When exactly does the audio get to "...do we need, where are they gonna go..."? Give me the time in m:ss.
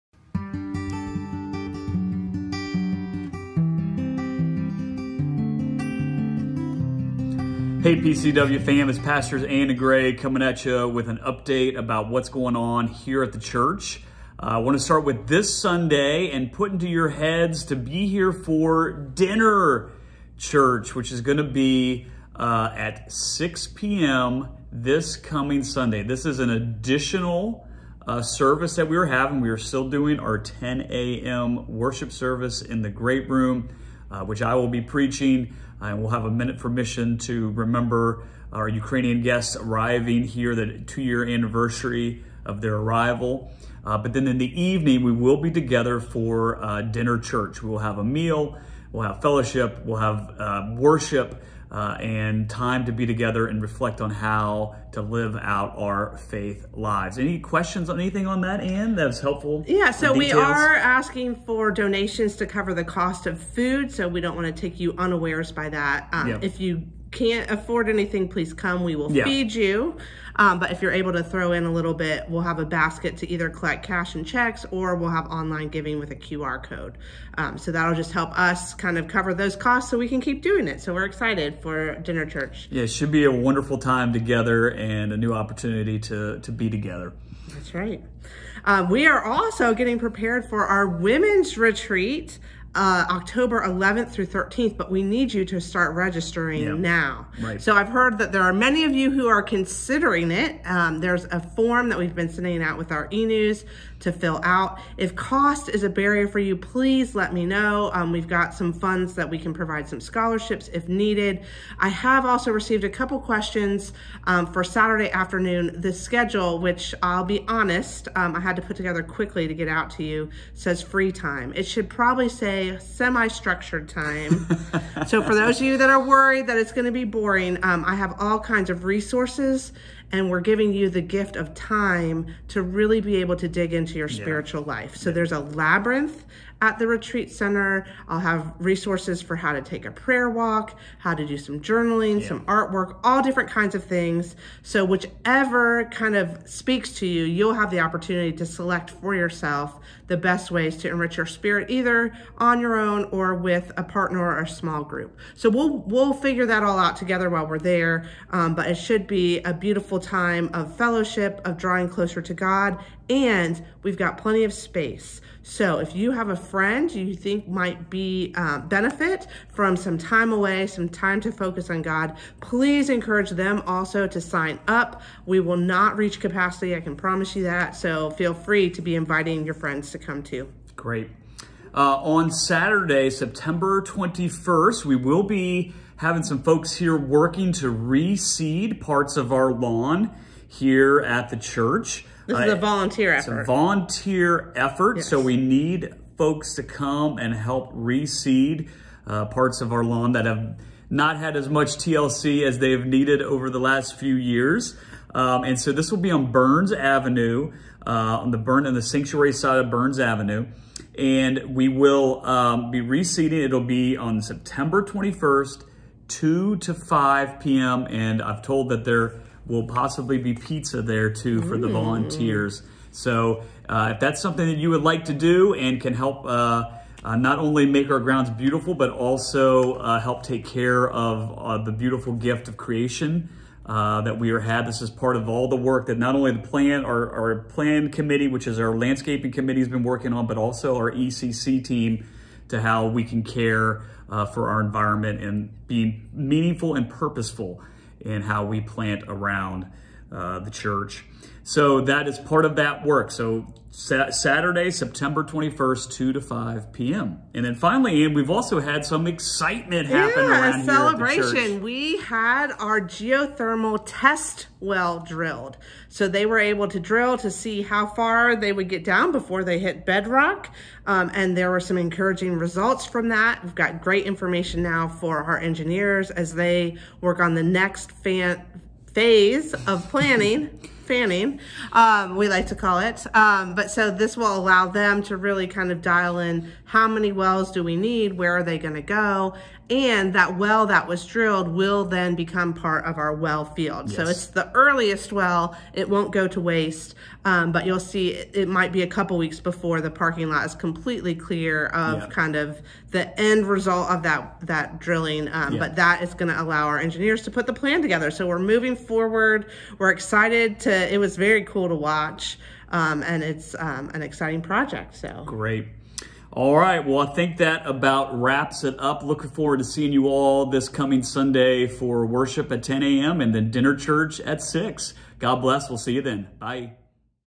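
4:47.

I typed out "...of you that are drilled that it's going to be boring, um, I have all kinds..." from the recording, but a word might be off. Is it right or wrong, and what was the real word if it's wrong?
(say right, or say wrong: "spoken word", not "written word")
wrong: "worried", not "drilled".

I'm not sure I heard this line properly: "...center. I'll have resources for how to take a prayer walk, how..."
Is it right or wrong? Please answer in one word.
right.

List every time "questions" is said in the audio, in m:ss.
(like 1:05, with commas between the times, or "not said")
0:57, 1:53.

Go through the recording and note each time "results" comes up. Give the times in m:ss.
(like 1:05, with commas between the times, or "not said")
4:32, 5:03.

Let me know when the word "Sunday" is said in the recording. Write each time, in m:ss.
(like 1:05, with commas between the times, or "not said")
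0:15, 0:25, 5:21.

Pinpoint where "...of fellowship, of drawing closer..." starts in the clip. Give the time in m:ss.
2:40.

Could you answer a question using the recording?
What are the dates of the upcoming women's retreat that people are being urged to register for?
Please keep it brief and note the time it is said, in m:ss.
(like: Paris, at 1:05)
October 11th through 13th, at 1:33.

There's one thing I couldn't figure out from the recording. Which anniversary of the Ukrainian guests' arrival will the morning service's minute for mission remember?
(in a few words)
two year.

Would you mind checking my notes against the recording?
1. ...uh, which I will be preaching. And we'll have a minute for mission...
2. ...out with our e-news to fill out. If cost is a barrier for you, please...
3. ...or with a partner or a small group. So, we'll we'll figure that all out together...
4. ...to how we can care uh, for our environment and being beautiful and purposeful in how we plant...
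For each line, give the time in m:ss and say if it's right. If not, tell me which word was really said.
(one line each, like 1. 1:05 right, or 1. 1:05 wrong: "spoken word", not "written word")
1. 0:34 right
2. 1:42 right
3. 2:33 right
4. 4:02 wrong: "meaningful", not "beautiful".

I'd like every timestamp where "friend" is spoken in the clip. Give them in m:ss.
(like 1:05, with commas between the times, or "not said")
2:46, 2:59.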